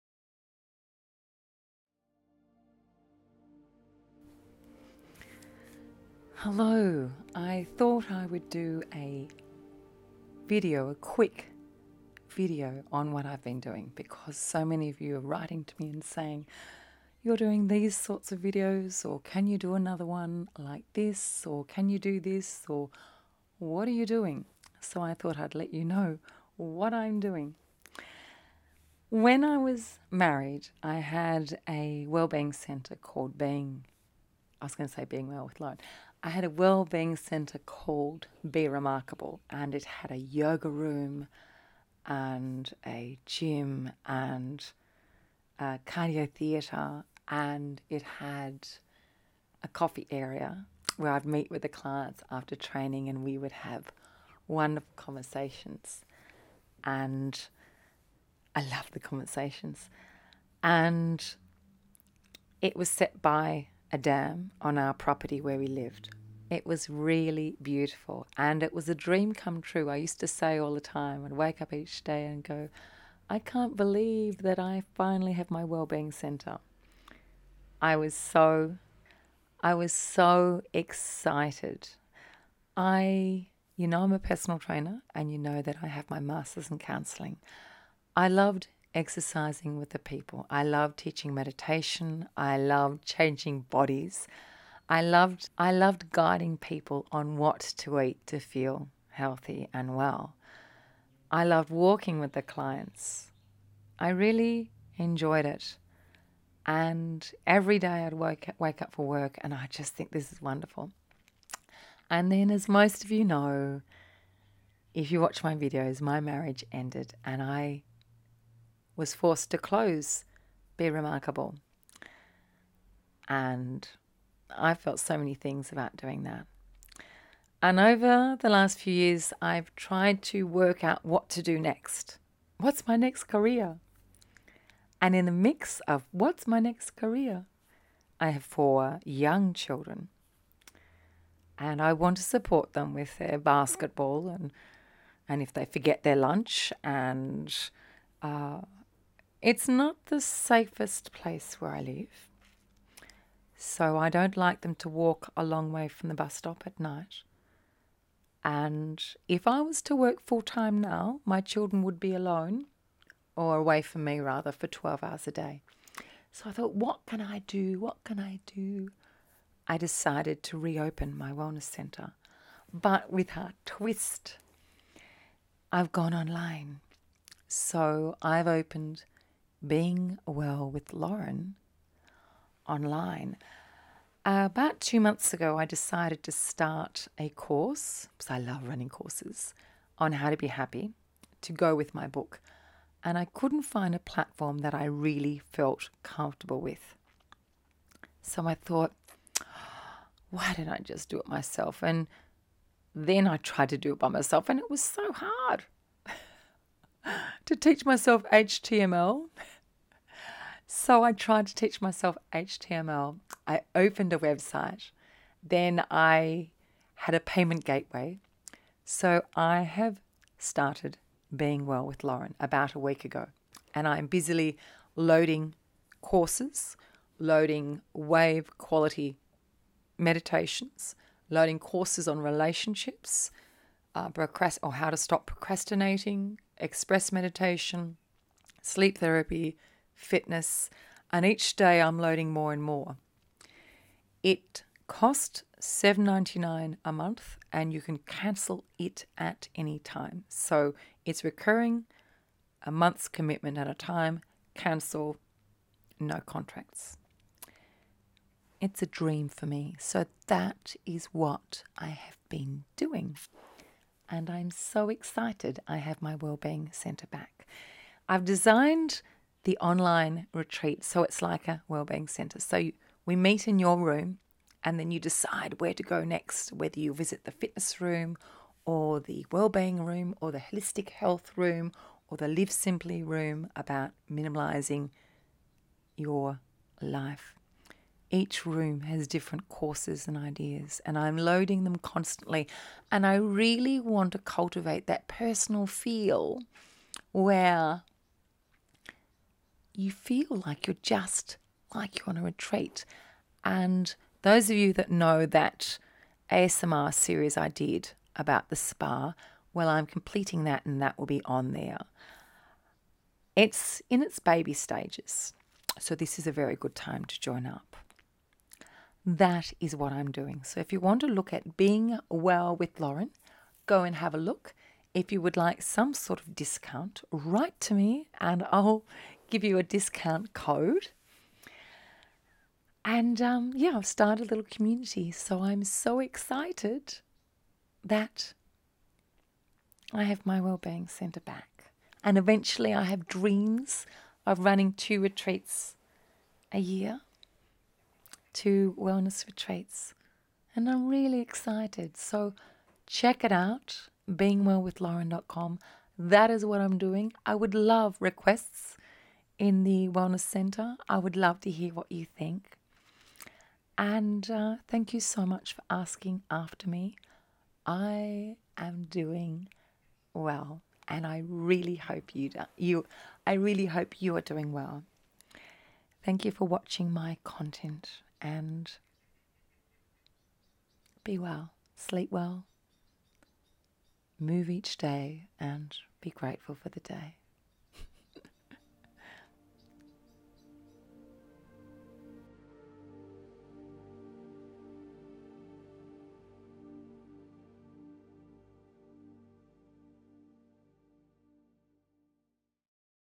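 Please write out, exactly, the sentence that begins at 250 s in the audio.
So it's recurring, a month's commitment at a time, cancel, no contracts.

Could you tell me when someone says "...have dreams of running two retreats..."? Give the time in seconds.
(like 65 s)
342 s.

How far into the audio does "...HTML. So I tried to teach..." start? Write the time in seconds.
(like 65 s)
208 s.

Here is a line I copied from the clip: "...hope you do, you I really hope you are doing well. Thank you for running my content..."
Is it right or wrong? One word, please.
wrong.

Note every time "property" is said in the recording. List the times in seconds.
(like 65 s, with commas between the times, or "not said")
64 s.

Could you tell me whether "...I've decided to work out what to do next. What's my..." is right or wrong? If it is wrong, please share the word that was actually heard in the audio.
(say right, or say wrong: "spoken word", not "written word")
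wrong: "tried", not "decided".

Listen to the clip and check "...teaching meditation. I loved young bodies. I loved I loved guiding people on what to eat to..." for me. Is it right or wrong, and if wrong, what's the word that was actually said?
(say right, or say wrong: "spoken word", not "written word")
wrong: "changing", not "young".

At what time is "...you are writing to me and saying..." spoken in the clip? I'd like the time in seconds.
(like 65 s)
14 s.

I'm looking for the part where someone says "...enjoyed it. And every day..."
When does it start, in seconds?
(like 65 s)
104 s.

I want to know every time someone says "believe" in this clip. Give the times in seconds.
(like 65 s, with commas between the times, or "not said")
73 s.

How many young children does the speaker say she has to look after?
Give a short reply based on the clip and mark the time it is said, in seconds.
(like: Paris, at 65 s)
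4, at 138 s.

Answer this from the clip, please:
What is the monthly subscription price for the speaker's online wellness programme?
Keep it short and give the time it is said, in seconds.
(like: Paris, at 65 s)
$7.99, at 245 s.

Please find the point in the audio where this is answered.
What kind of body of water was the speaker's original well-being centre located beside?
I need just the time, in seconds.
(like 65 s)
63 s.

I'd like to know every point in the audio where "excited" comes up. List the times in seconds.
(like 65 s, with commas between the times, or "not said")
80 s, 264 s, 335 s, 351 s.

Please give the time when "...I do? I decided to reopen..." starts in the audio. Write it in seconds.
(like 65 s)
168 s.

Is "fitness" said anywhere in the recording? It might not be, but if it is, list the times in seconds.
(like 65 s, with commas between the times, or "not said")
240 s, 277 s.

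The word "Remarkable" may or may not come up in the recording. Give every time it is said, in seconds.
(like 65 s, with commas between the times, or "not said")
38 s, 120 s.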